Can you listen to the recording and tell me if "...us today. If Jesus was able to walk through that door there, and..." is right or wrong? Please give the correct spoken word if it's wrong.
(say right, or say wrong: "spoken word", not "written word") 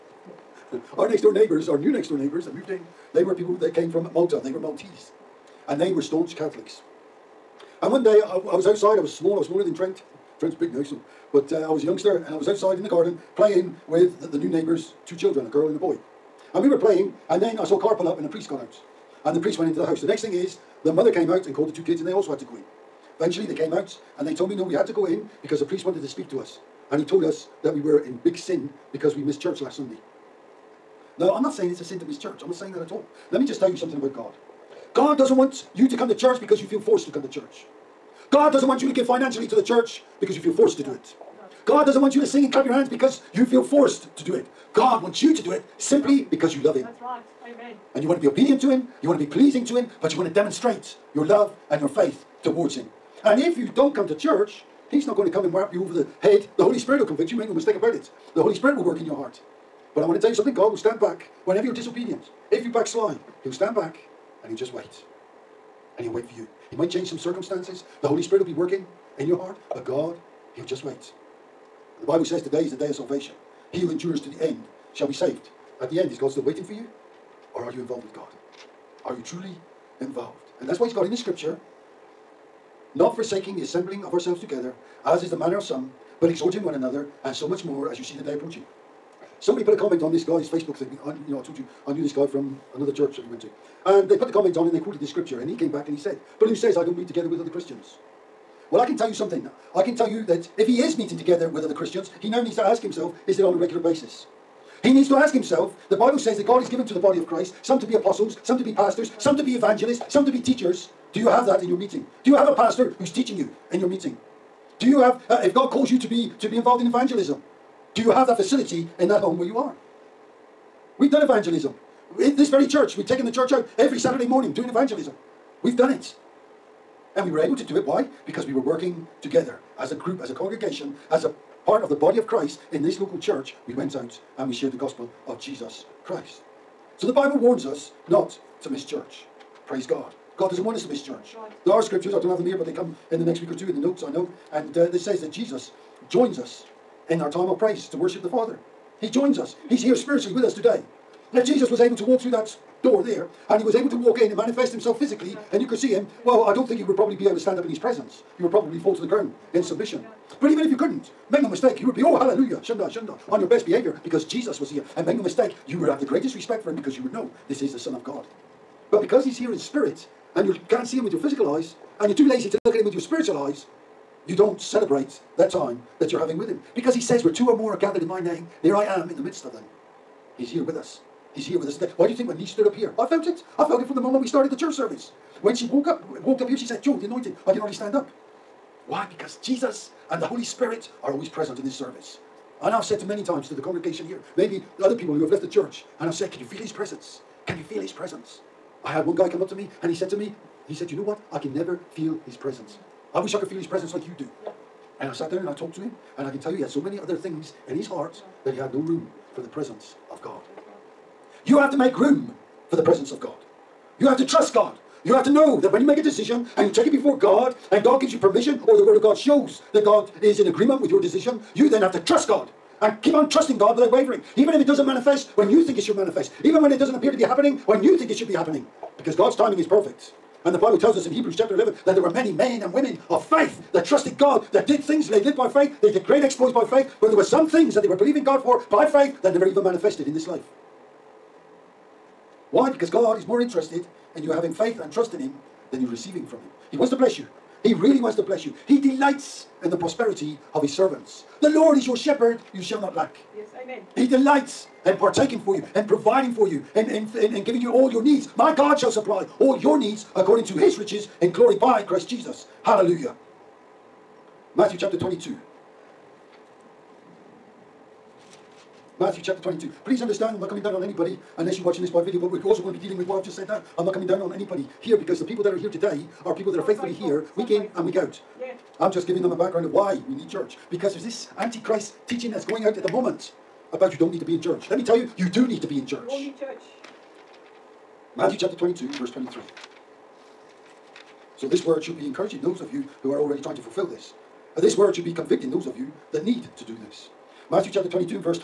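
right.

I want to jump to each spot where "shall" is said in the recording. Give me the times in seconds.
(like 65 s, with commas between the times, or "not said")
74 s, 252 s, 258 s.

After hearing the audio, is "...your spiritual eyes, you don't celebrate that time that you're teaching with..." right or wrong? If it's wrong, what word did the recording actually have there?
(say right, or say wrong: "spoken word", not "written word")
wrong: "having", not "teaching".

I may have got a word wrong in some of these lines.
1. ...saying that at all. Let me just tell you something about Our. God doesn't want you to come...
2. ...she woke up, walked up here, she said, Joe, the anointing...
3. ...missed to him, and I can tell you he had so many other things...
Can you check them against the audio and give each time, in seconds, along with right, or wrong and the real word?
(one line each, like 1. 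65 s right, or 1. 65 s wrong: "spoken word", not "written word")
1. 32 s wrong: "God", not "Our"
2. 185 s right
3. 205 s wrong: "talked", not "missed".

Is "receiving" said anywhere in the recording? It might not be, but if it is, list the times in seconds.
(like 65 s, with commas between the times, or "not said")
245 s.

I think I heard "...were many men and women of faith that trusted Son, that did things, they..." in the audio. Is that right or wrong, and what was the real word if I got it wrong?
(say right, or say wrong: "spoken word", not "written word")
wrong: "God", not "Son".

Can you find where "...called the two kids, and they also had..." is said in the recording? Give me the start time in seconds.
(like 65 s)
21 s.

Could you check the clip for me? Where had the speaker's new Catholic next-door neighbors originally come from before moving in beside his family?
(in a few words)
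Malta.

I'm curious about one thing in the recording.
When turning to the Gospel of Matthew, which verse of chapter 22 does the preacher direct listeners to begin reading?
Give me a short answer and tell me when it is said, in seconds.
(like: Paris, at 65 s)
23, at 288 s.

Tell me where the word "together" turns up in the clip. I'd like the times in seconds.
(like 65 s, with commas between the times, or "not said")
84 s, 97 s, 101 s, 129 s.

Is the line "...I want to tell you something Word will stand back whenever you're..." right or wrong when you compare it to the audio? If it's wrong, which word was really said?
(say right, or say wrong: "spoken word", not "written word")
wrong: "God", not "Word".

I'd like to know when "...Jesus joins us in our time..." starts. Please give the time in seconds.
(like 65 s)
145 s.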